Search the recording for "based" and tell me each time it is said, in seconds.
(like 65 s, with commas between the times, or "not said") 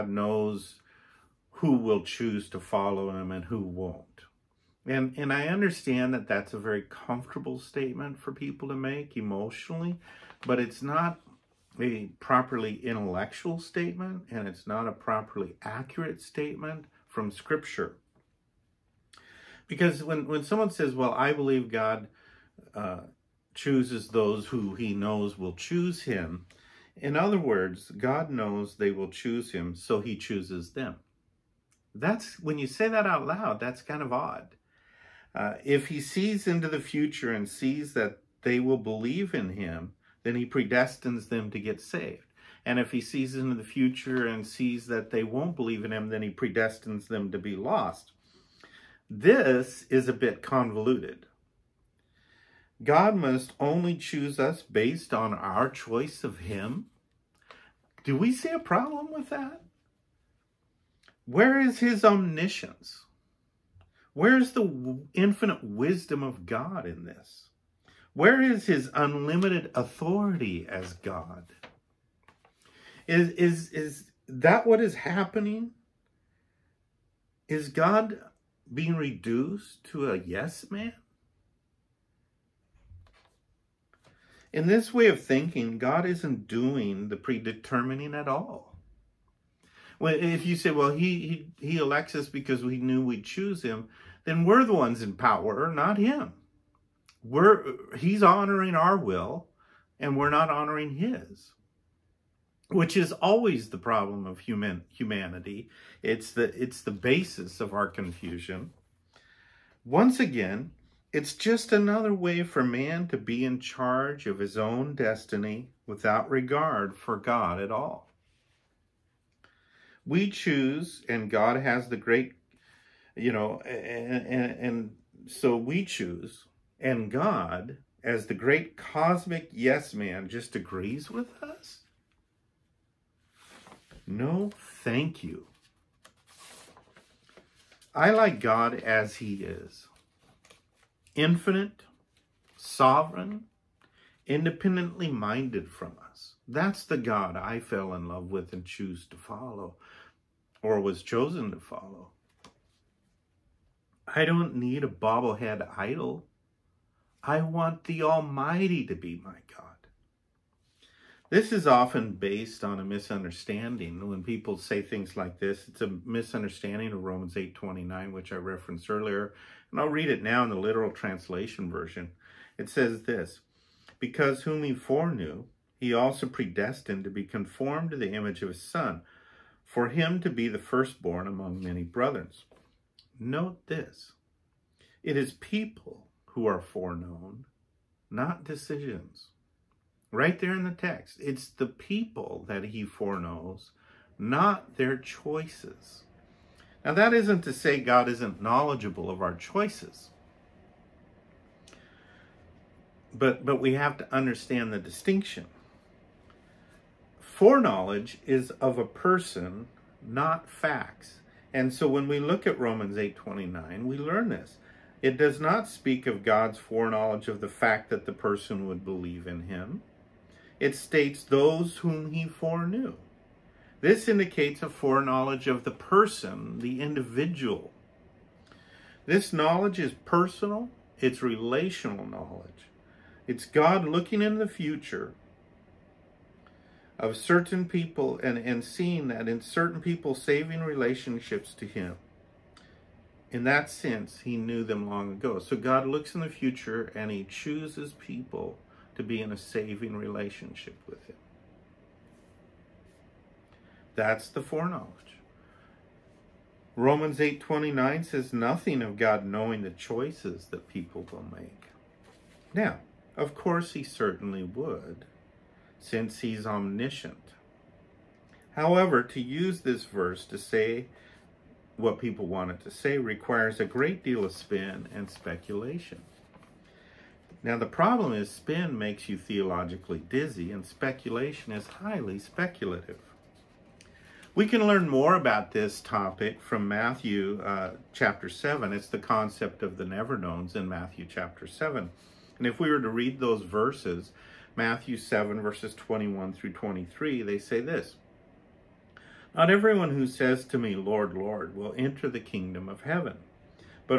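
54 s, 162 s.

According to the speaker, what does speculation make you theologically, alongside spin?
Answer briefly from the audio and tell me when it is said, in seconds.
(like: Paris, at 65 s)
dizzy, at 279 s.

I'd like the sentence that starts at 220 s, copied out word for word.
It states those whom he foreknew.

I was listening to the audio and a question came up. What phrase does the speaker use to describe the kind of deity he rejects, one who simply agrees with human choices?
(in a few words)
cosmic yes man.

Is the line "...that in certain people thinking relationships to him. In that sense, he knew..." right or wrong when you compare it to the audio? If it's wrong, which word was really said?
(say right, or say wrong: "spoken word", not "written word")
wrong: "saving", not "thinking".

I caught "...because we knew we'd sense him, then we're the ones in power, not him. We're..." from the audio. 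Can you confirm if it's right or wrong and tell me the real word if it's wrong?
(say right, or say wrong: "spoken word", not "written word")
wrong: "choose", not "sense".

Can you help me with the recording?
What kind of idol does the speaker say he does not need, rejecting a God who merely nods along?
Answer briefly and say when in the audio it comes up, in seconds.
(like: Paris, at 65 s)
bobblehead idol, at 154 s.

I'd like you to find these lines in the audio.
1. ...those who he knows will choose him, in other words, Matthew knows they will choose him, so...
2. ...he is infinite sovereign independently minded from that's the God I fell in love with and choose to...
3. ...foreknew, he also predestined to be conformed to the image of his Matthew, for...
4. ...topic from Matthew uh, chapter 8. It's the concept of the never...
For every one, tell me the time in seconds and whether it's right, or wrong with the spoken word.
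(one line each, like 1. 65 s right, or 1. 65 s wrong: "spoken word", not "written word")
1. 24 s wrong: "God", not "Matthew"
2. 139 s right
3. 174 s wrong: "Son", not "Matthew"
4. 285 s wrong: "7", not "8".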